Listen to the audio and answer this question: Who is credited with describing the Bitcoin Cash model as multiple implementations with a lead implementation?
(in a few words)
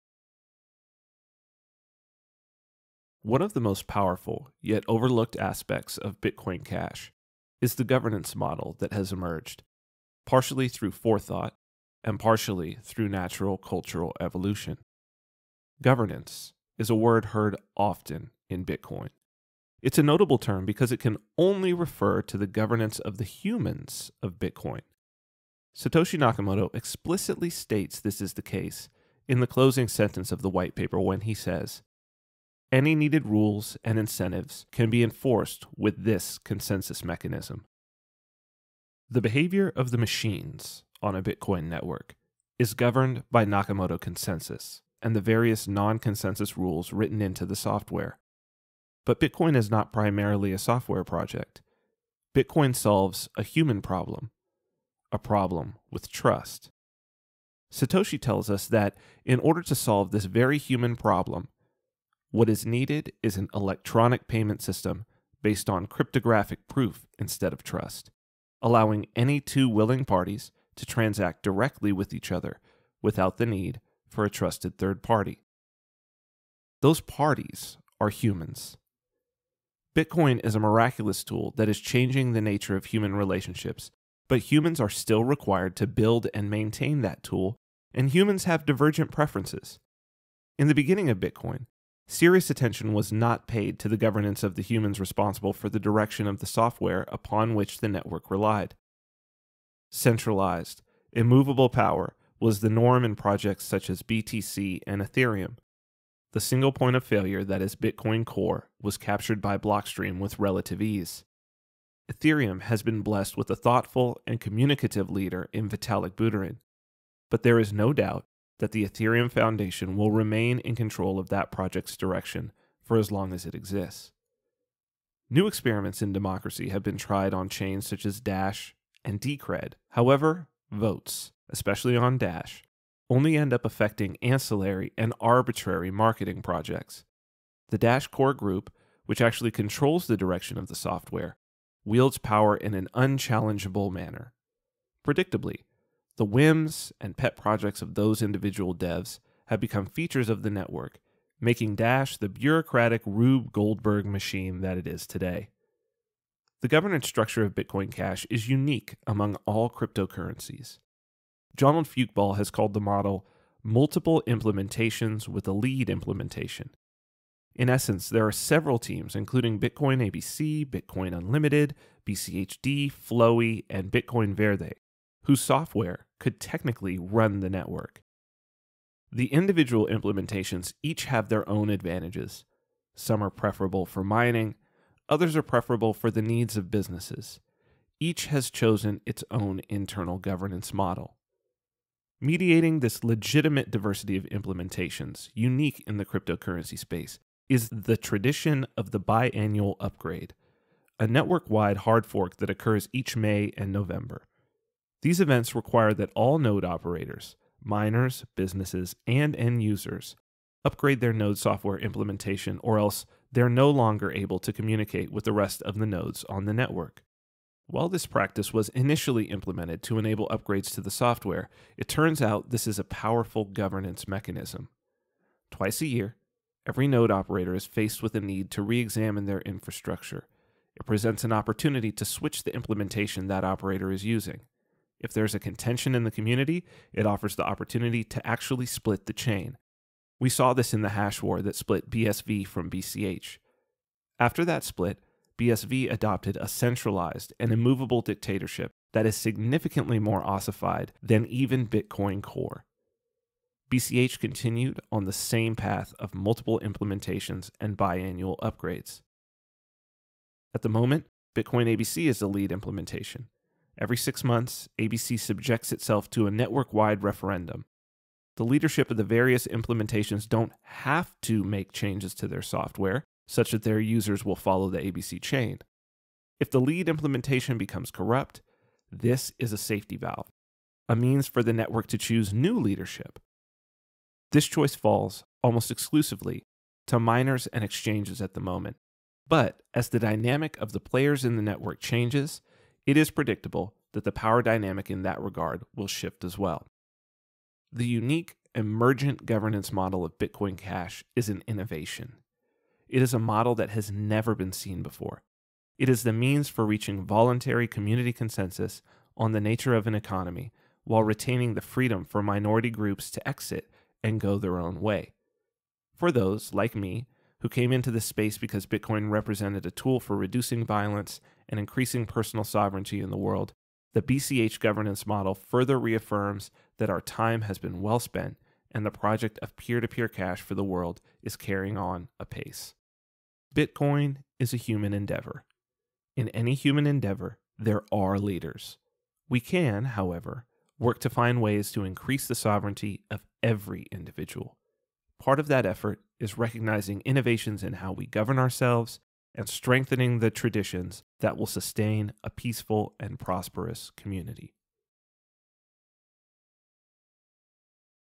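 Jonald Fyookball.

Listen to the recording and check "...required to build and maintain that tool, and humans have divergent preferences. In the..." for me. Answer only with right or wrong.
right.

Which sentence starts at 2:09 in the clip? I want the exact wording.
However, votes, especially on Dash, only end up affecting ancillary and arbitrary marketing projects.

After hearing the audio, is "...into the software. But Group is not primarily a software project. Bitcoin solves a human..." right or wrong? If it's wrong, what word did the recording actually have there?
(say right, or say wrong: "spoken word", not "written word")
wrong: "Bitcoin", not "Group".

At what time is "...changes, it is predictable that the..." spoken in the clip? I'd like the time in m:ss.
4:51.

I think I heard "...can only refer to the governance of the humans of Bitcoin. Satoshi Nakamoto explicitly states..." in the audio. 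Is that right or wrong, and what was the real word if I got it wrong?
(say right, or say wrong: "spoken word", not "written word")
right.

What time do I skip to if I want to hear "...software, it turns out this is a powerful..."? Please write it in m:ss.
3:40.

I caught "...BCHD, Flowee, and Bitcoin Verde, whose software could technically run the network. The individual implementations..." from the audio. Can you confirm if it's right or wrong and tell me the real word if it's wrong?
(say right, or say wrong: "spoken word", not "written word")
right.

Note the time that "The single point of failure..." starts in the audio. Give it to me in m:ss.
1:46.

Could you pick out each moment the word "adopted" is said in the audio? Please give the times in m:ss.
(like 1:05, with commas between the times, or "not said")
4:05.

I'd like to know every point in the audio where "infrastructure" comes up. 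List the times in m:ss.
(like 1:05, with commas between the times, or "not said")
3:49.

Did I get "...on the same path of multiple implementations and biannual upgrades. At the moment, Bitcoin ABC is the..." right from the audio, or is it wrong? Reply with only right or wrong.
right.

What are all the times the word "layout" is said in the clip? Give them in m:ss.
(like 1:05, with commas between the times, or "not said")
not said.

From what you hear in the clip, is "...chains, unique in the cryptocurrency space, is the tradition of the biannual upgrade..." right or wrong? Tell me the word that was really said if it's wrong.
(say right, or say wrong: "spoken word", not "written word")
wrong: "implementations", not "chains".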